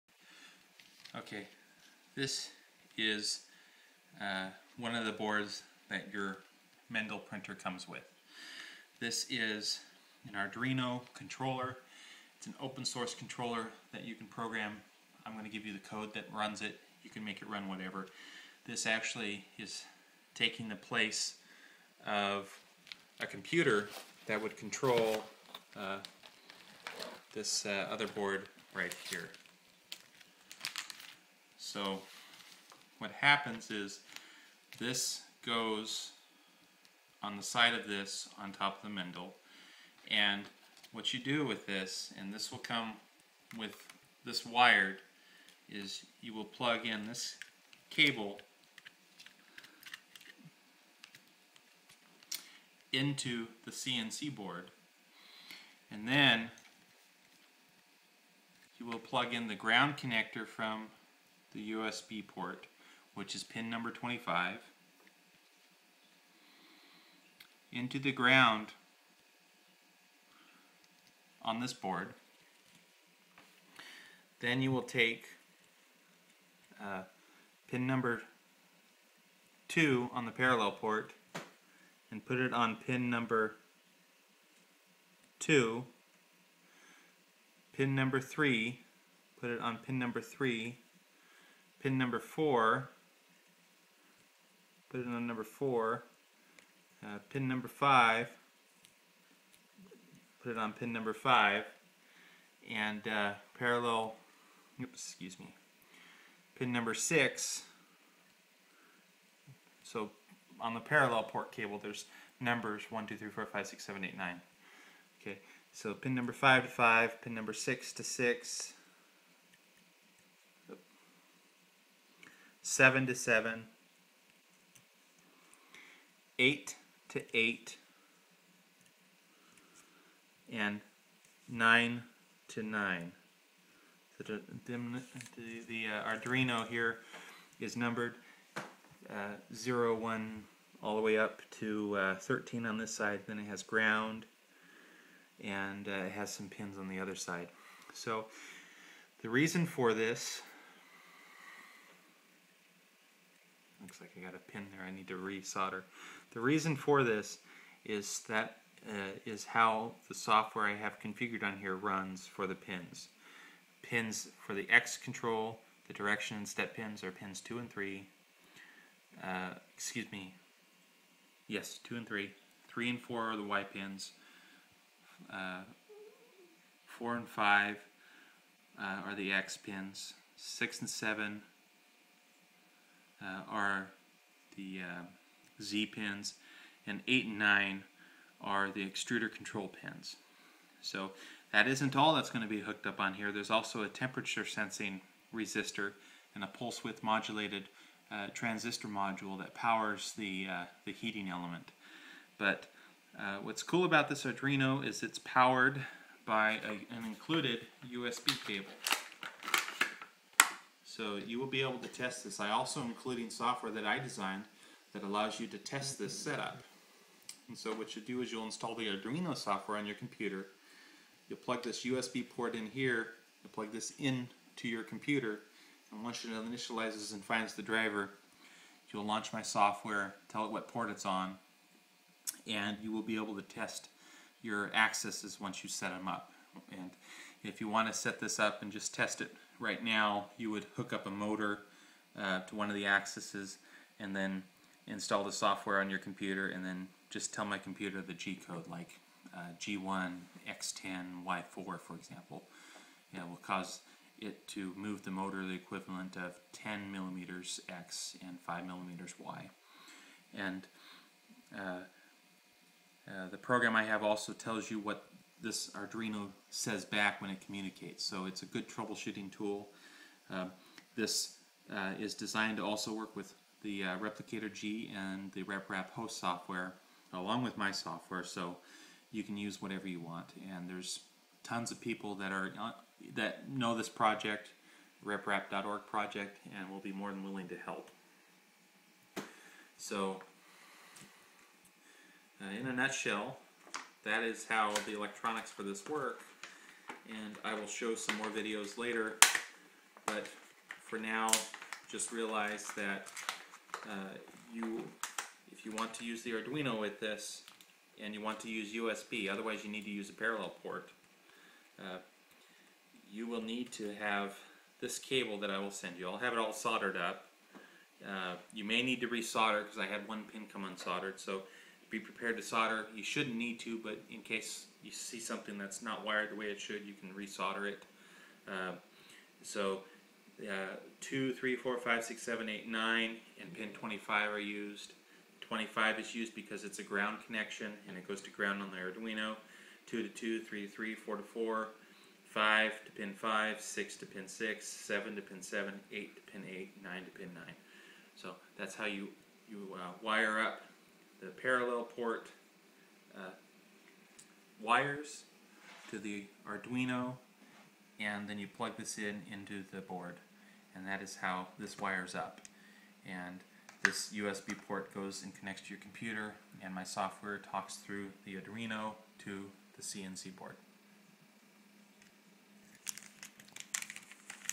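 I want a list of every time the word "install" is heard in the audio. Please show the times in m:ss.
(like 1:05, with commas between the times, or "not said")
3:38, 4:04.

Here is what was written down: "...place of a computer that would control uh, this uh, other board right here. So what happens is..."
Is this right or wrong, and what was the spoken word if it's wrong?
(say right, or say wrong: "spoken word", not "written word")
right.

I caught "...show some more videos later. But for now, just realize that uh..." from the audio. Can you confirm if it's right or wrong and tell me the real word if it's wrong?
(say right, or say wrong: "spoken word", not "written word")
right.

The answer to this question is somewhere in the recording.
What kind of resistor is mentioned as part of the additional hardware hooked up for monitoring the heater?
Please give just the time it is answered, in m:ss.
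3:13.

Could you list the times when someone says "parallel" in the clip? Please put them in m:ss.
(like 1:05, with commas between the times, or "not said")
1:20, 1:43, 1:50, 5:10, 5:51.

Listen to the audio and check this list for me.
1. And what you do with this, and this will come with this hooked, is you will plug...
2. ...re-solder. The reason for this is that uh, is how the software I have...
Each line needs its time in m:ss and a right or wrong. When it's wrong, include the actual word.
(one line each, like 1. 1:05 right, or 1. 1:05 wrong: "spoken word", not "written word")
1. 0:40 wrong: "wired", not "hooked"
2. 2:35 right.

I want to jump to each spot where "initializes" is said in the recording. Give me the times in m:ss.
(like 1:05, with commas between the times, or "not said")
3:46.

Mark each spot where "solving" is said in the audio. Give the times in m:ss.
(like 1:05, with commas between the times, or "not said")
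not said.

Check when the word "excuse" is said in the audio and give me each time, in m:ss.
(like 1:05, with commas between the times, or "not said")
1:45, 2:49.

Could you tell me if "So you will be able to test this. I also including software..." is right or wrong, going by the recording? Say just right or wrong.
right.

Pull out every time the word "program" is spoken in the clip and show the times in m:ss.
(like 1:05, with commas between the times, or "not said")
0:14, 4:23.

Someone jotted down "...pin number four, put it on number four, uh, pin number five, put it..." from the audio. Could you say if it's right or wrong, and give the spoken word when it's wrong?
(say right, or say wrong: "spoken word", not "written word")
right.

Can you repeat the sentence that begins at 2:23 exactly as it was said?
Then it has ground, and uh, it has some pins on the other side.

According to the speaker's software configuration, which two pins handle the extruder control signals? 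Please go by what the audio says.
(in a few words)
8 and 9.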